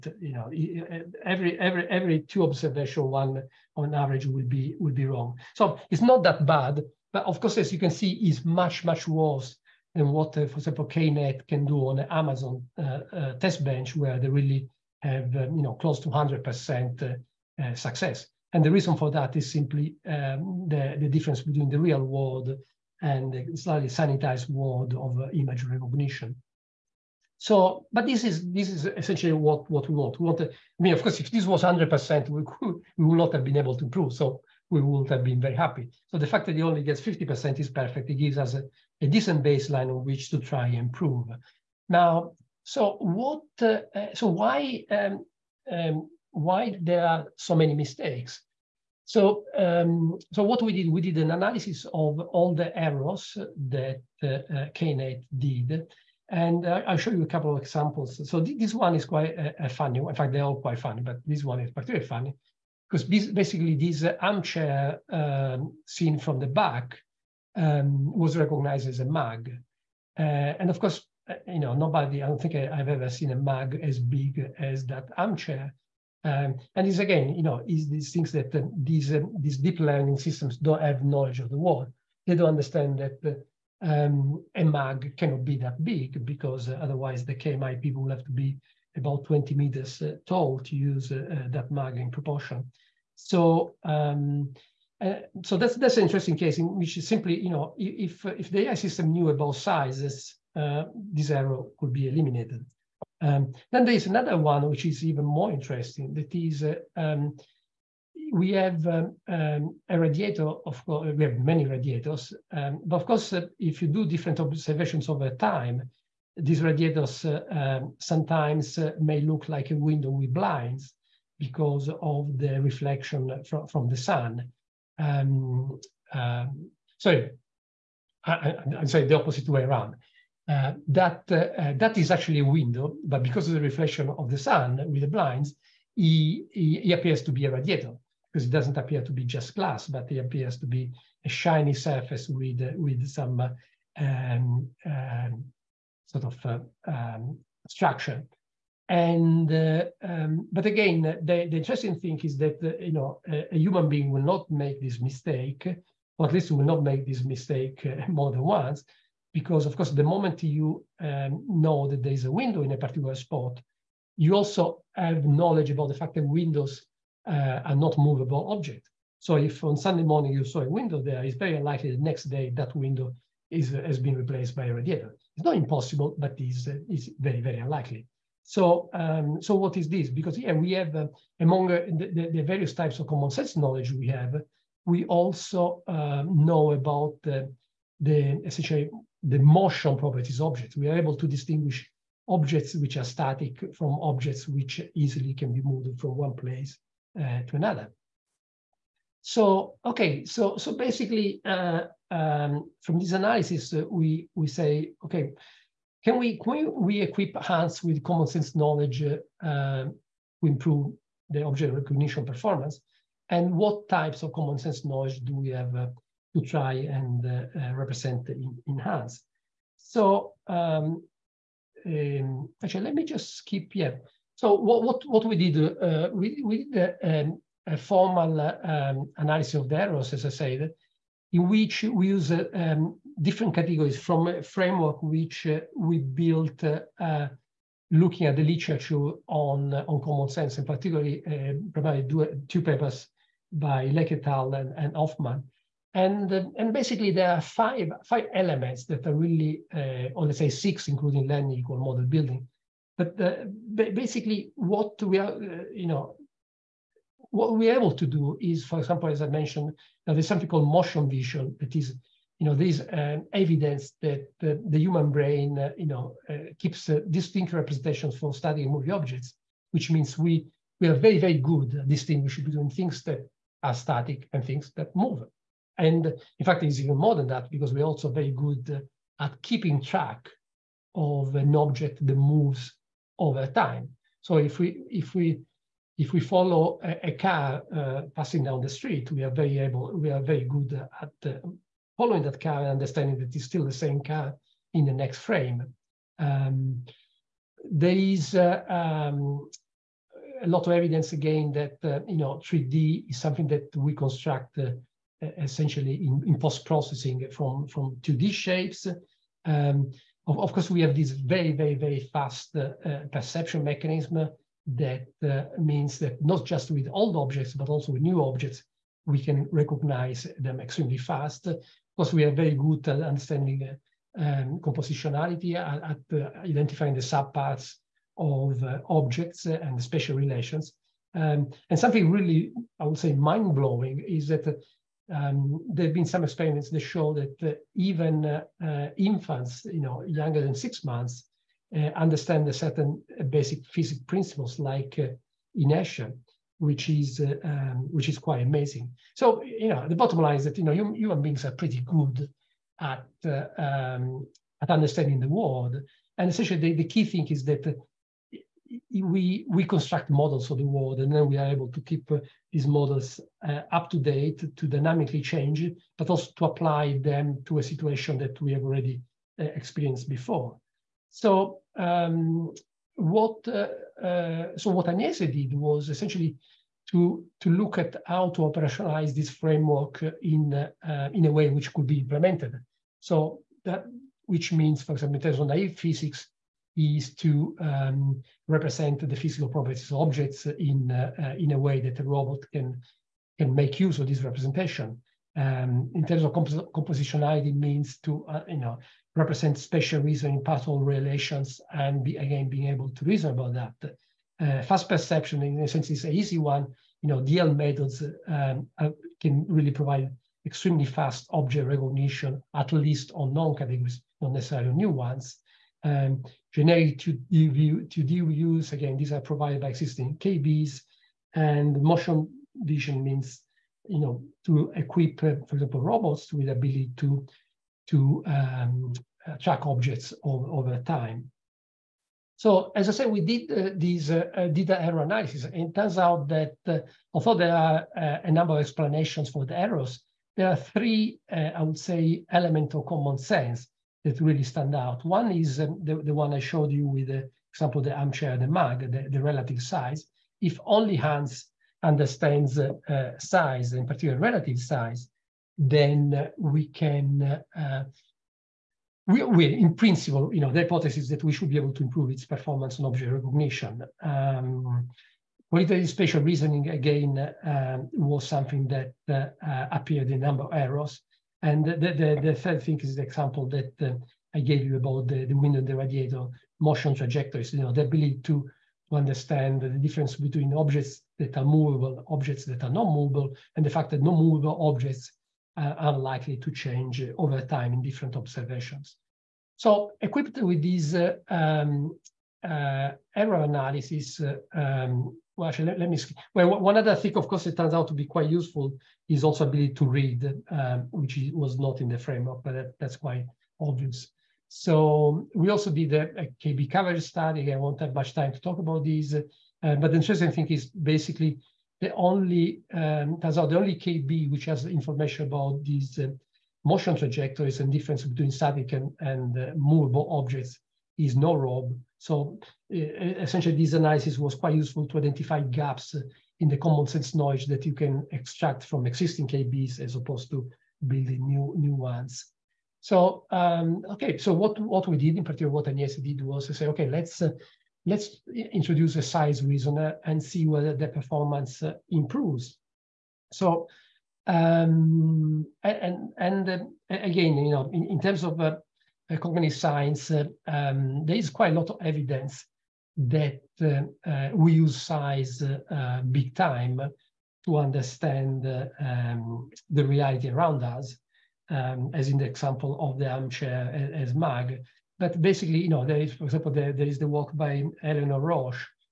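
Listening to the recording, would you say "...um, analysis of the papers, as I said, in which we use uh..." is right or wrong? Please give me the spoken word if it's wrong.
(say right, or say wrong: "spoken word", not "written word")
wrong: "errors", not "papers".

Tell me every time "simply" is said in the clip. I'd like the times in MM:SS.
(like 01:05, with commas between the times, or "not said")
00:19, 01:37.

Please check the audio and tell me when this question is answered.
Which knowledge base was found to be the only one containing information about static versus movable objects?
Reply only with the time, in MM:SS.
08:41.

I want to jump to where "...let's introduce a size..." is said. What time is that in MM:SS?
08:57.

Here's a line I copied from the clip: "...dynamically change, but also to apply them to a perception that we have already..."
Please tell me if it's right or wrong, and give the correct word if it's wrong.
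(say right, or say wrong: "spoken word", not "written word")
wrong: "situation", not "perception".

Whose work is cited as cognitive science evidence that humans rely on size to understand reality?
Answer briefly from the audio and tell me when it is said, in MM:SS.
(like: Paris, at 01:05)
Eleanor Rosch, at 09:27.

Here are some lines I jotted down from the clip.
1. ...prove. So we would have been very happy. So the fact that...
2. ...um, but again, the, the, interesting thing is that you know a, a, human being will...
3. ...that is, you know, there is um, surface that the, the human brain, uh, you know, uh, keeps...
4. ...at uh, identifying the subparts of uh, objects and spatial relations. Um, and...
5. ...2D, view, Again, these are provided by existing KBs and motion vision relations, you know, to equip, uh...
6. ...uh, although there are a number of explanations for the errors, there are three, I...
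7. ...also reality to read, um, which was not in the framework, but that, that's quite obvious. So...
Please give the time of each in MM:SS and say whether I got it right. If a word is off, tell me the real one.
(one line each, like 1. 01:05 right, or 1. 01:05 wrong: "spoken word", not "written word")
1. 00:33 right
2. 02:30 right
3. 04:21 wrong: "evidence", not "surface"
4. 05:25 right
5. 06:56 wrong: "means", not "relations"
6. 07:16 right
7. 08:19 wrong: "ability", not "reality".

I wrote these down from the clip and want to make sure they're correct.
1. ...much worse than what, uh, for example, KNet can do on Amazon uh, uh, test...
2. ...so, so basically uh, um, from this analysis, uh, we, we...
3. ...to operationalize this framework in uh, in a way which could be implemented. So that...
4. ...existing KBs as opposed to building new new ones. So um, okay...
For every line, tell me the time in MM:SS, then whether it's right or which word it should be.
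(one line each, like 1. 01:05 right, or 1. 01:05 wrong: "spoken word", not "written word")
1. 00:08 right
2. 03:20 right
3. 06:18 right
4. 08:48 right.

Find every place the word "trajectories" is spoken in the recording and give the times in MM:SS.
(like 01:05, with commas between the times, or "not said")
07:56, 08:36.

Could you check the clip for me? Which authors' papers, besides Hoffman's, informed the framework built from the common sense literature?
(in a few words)
Lake et al.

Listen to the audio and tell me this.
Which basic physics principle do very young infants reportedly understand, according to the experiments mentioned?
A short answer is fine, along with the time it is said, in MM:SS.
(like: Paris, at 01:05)
Inertia, at 05:45.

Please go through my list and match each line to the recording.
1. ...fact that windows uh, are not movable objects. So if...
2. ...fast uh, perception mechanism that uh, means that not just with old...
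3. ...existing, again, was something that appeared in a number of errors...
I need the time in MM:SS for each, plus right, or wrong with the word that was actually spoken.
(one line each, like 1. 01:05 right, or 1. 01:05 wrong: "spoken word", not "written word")
1. 02:46 right
2. 05:12 right
3. 07:46 wrong: "reasoning", not "existing".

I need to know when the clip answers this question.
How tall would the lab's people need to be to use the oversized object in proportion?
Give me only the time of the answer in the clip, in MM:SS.
01:29.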